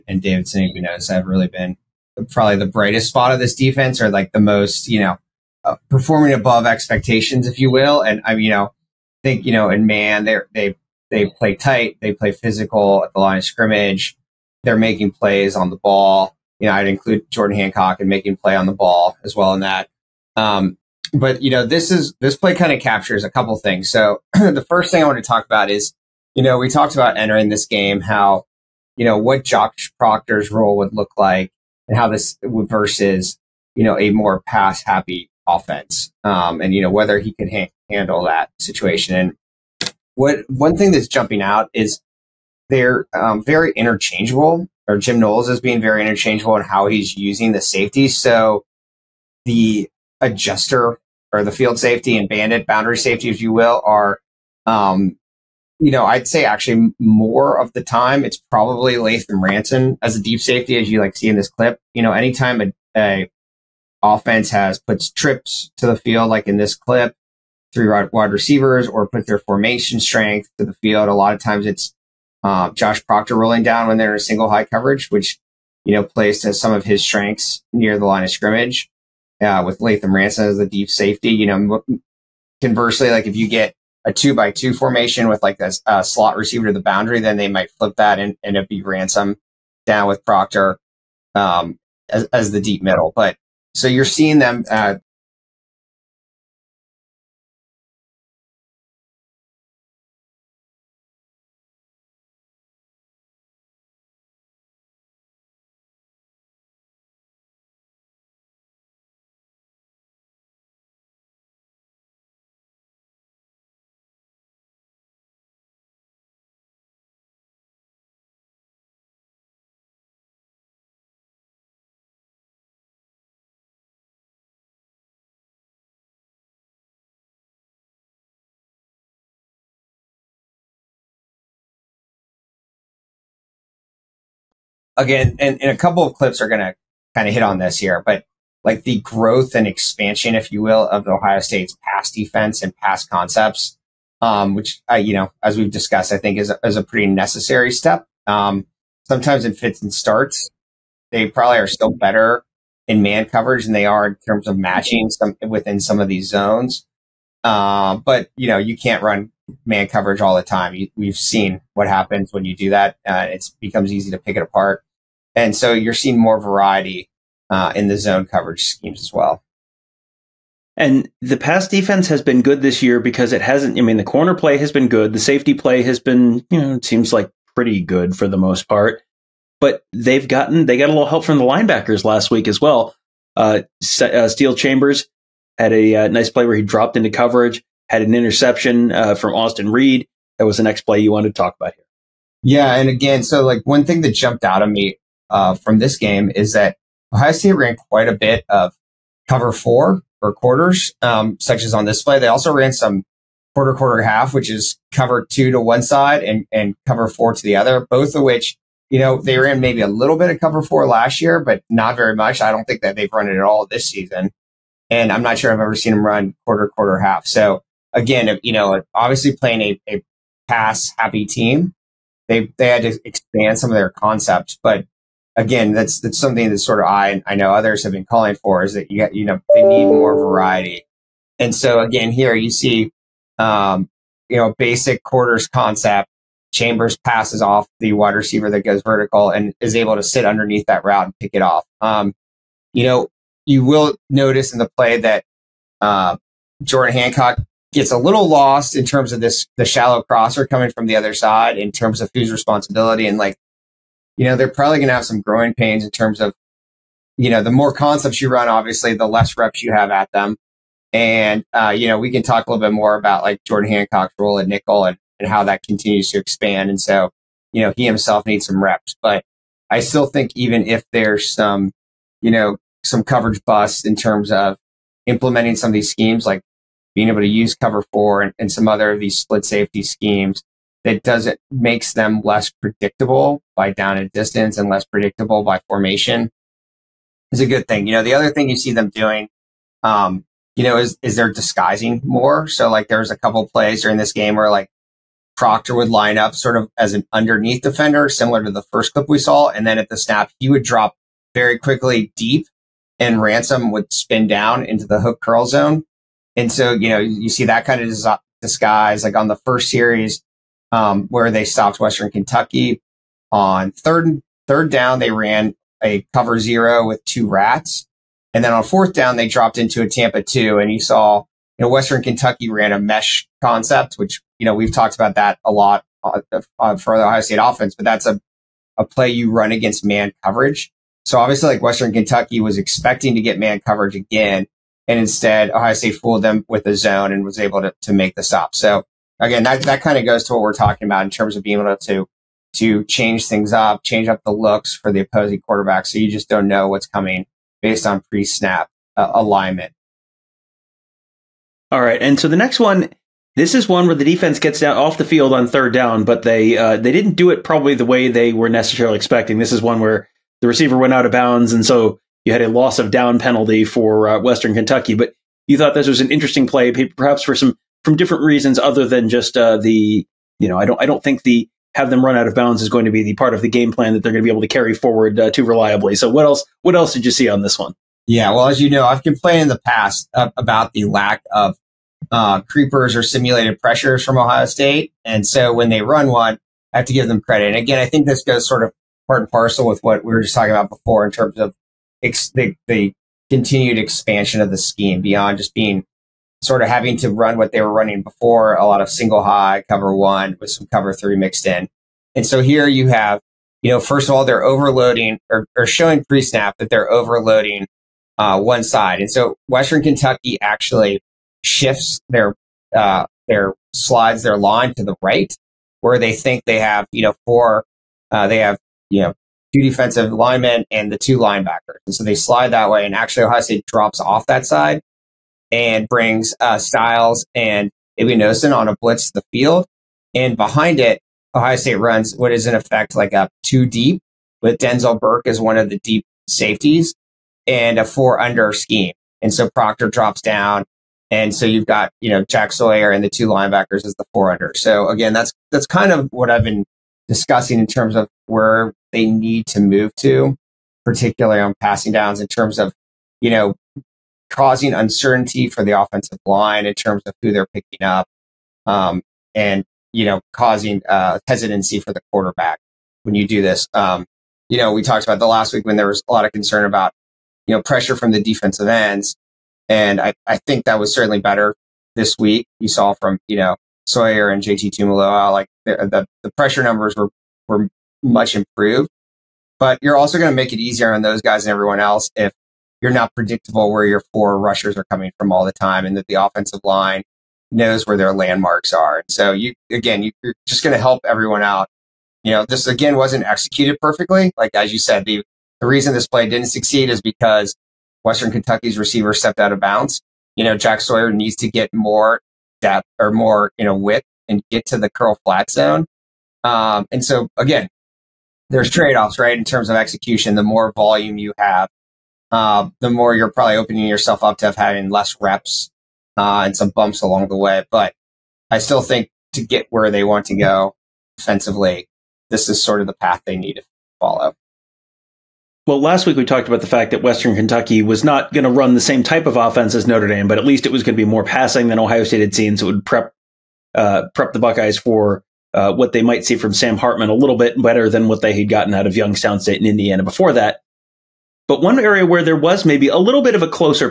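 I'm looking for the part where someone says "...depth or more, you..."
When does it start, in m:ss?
8:22.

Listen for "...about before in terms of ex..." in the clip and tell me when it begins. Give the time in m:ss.
6:30.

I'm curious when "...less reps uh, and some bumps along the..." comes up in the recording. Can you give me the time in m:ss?
8:34.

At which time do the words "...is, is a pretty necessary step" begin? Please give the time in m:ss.
2:26.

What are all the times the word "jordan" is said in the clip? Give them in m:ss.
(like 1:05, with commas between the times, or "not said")
0:17, 4:06, 4:23.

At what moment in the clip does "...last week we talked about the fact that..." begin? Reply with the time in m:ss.
8:45.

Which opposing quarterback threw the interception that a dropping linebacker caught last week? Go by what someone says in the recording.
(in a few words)
Austin Reed.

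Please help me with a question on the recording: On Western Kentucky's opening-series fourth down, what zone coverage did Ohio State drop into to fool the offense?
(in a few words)
Tampa two.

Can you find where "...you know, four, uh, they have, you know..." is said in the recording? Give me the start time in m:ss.
6:56.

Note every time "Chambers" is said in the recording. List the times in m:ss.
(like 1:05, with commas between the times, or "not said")
3:04, 3:56.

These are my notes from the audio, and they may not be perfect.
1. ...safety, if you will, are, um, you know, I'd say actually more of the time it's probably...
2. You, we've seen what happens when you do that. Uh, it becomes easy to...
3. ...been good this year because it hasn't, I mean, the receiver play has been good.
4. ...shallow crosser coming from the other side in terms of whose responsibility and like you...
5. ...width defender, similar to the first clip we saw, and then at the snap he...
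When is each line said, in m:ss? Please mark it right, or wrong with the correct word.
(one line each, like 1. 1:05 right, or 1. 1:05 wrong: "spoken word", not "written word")
1. 0:52 right
2. 2:40 right
3. 2:52 wrong: "corner", not "receiver"
4. 4:09 right
5. 4:57 wrong: "underneath", not "width".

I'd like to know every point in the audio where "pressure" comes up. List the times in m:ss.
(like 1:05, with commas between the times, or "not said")
6:23, 7:47, 7:56.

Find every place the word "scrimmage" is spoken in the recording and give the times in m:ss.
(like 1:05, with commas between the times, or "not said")
0:13, 1:18.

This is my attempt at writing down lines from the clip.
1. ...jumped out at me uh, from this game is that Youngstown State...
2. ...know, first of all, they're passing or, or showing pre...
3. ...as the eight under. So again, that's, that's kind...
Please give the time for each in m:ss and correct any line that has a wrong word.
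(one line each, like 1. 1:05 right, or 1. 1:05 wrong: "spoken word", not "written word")
1. 3:14 wrong: "Ohio", not "Youngstown"
2. 6:43 wrong: "overloading", not "passing"
3. 7:23 wrong: "four", not "eight".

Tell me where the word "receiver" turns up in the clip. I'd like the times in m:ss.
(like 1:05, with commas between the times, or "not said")
1:08, 1:26, 3:58, 6:00, 8:18.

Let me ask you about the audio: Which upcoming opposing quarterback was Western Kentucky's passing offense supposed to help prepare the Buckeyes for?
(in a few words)
Sam Hartman.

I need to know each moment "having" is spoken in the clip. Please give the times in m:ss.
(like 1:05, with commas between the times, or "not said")
6:36, 8:34.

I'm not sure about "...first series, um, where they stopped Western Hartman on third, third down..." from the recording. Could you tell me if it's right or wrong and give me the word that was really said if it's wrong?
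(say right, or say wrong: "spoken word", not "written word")
wrong: "Kentucky", not "Hartman".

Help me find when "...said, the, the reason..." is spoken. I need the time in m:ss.
8:14.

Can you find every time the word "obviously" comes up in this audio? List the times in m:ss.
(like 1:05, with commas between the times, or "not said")
3:38, 4:18, 5:31.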